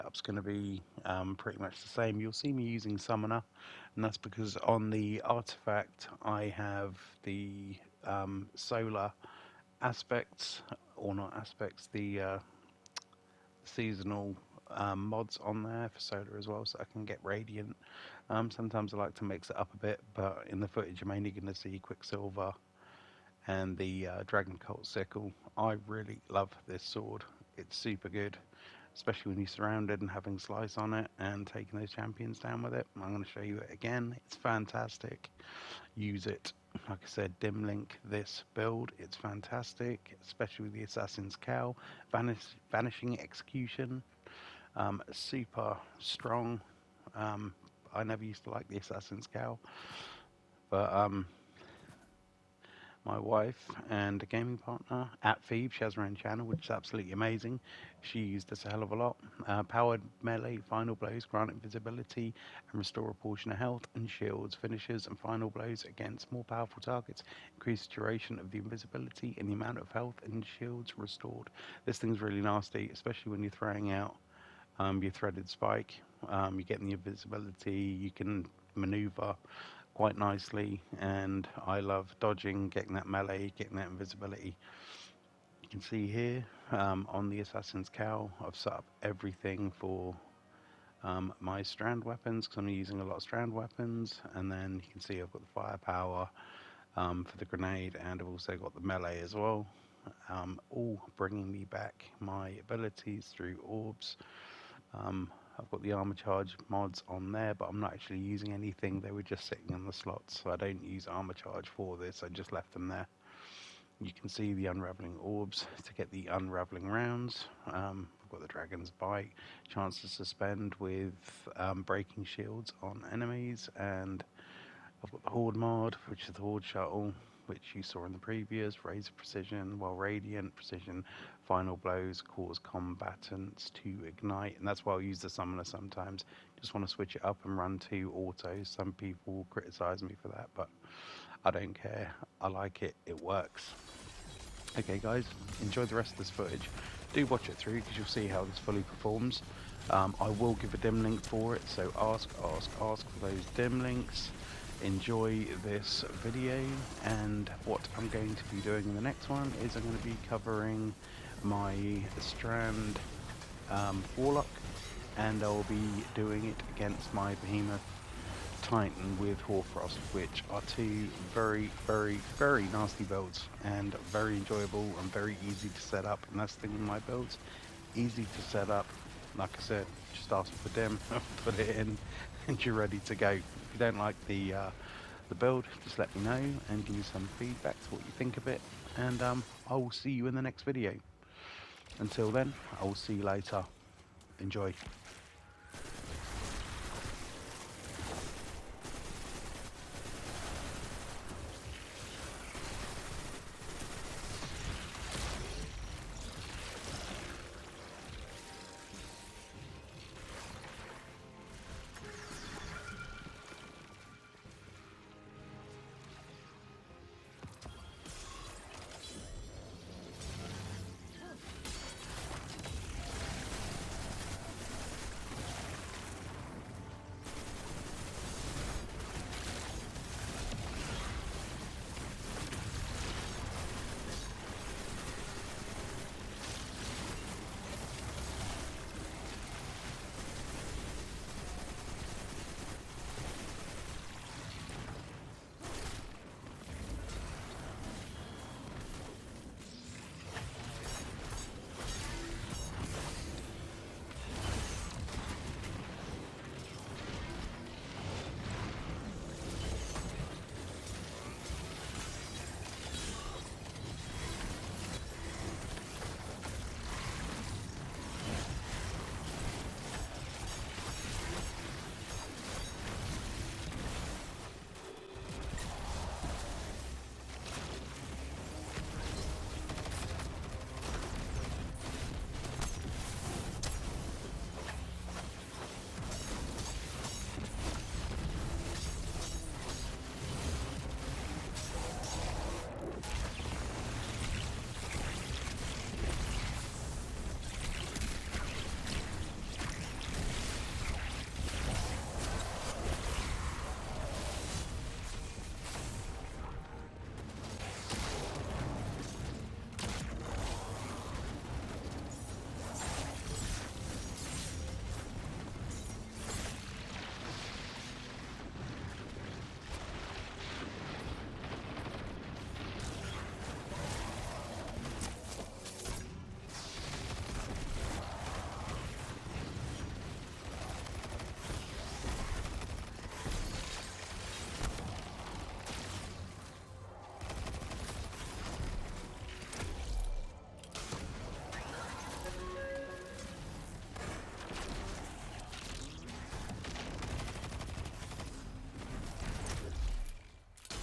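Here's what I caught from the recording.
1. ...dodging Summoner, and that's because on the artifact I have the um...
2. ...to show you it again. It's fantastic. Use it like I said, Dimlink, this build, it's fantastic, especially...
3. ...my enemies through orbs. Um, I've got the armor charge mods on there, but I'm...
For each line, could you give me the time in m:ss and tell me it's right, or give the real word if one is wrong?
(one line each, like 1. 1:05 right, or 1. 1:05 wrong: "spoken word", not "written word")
1. 0:02 wrong: "using", not "dodging"
2. 0:33 right
3. 1:42 wrong: "abilities", not "enemies".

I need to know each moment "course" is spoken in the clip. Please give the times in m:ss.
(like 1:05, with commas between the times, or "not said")
not said.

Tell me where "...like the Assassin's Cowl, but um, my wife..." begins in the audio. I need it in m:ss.
0:48.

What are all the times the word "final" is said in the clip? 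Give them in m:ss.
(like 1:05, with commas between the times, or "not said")
1:00, 1:05, 2:11.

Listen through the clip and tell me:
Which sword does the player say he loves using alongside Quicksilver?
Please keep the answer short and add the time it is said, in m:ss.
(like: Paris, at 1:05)
Dragon Cult Sickle, at 0:24.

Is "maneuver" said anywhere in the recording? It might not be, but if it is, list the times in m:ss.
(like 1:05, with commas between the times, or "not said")
1:18.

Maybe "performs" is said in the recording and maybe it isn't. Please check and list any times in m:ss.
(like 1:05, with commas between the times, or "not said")
2:28.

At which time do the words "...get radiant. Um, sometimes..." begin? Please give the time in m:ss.
0:17.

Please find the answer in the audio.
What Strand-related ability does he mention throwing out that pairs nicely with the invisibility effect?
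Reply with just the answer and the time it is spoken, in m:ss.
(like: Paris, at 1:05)
threaded spike, at 1:15.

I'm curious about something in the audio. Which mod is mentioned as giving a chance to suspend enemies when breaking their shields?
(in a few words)
dragon's bite.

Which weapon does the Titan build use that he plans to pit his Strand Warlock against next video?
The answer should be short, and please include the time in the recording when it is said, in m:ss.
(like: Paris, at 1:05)
Hoarfrost, at 2:49.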